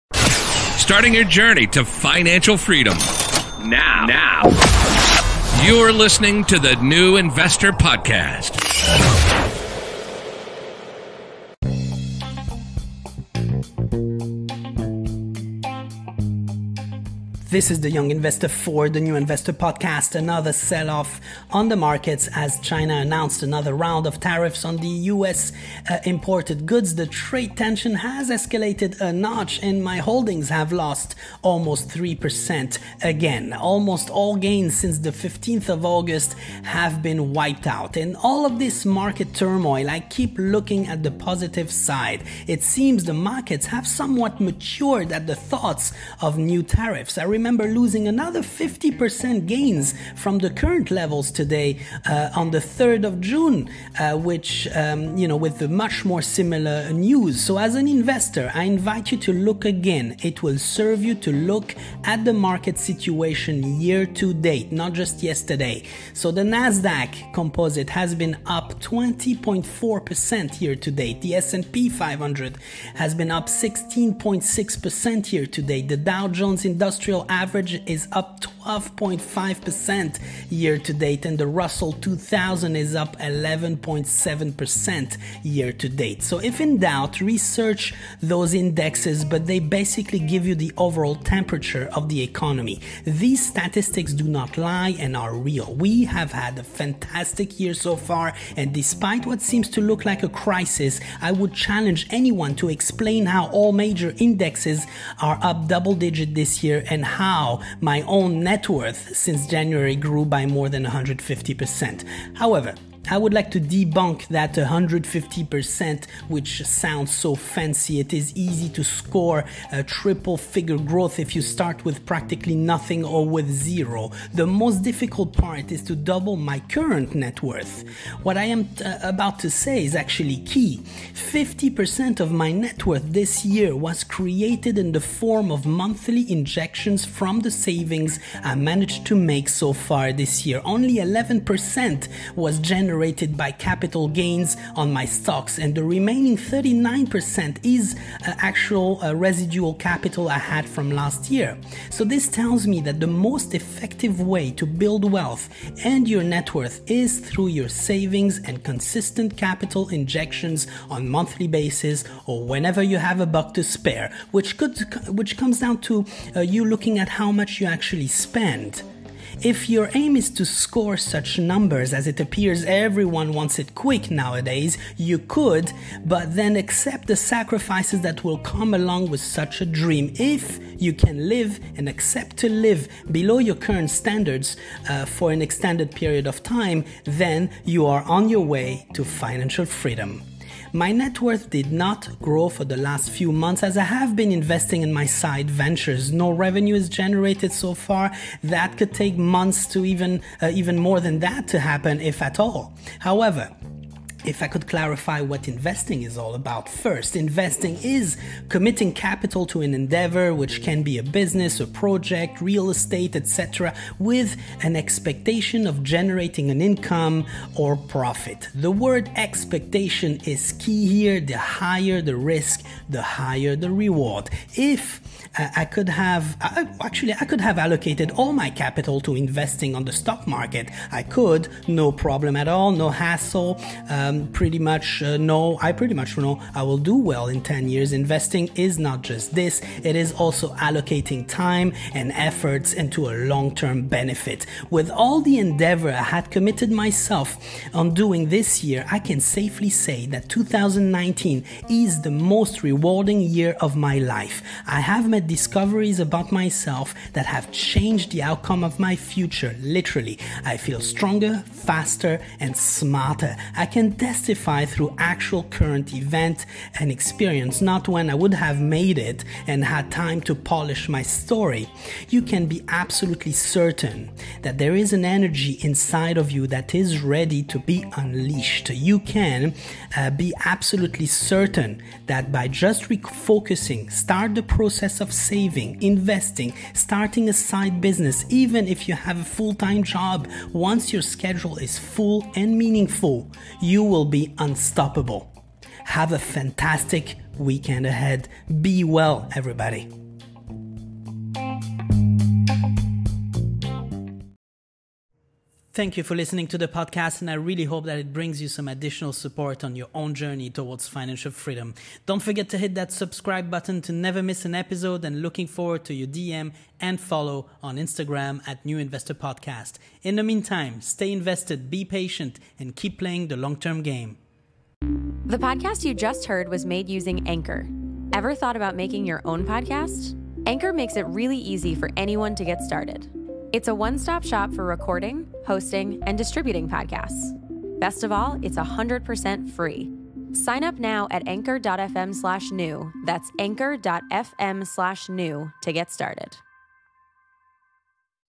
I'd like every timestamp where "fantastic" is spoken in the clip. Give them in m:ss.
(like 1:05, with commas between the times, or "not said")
1:36, 4:56.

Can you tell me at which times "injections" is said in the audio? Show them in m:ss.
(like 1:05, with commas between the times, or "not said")
2:16, 2:39.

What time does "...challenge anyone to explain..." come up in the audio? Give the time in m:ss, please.
1:41.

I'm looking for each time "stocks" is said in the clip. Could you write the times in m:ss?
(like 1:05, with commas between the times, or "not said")
2:25, 3:49.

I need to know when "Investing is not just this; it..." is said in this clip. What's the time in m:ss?
3:57.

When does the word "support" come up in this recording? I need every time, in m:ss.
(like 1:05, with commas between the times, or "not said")
5:09.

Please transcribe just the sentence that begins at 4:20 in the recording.
I feel stronger, faster, and smarter.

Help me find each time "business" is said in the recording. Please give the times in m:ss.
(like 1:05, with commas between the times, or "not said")
3:31, 4:47.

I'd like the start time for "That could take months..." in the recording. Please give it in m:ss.
3:18.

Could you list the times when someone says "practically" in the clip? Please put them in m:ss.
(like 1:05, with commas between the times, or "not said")
2:02.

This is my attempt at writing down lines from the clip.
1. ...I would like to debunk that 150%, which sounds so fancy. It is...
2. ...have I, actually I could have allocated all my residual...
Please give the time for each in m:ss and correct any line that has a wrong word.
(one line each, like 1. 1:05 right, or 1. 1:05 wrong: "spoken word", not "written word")
1. 1:53 right
2. 3:45 wrong: "capital", not "residual".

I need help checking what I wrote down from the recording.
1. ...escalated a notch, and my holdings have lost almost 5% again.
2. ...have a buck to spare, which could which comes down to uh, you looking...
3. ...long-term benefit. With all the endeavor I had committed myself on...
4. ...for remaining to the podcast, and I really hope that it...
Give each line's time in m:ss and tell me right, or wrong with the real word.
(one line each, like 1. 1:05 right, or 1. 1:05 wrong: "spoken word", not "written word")
1. 0:28 wrong: "3", not "5"
2. 2:42 right
3. 4:03 right
4. 5:06 wrong: "listening", not "remaining".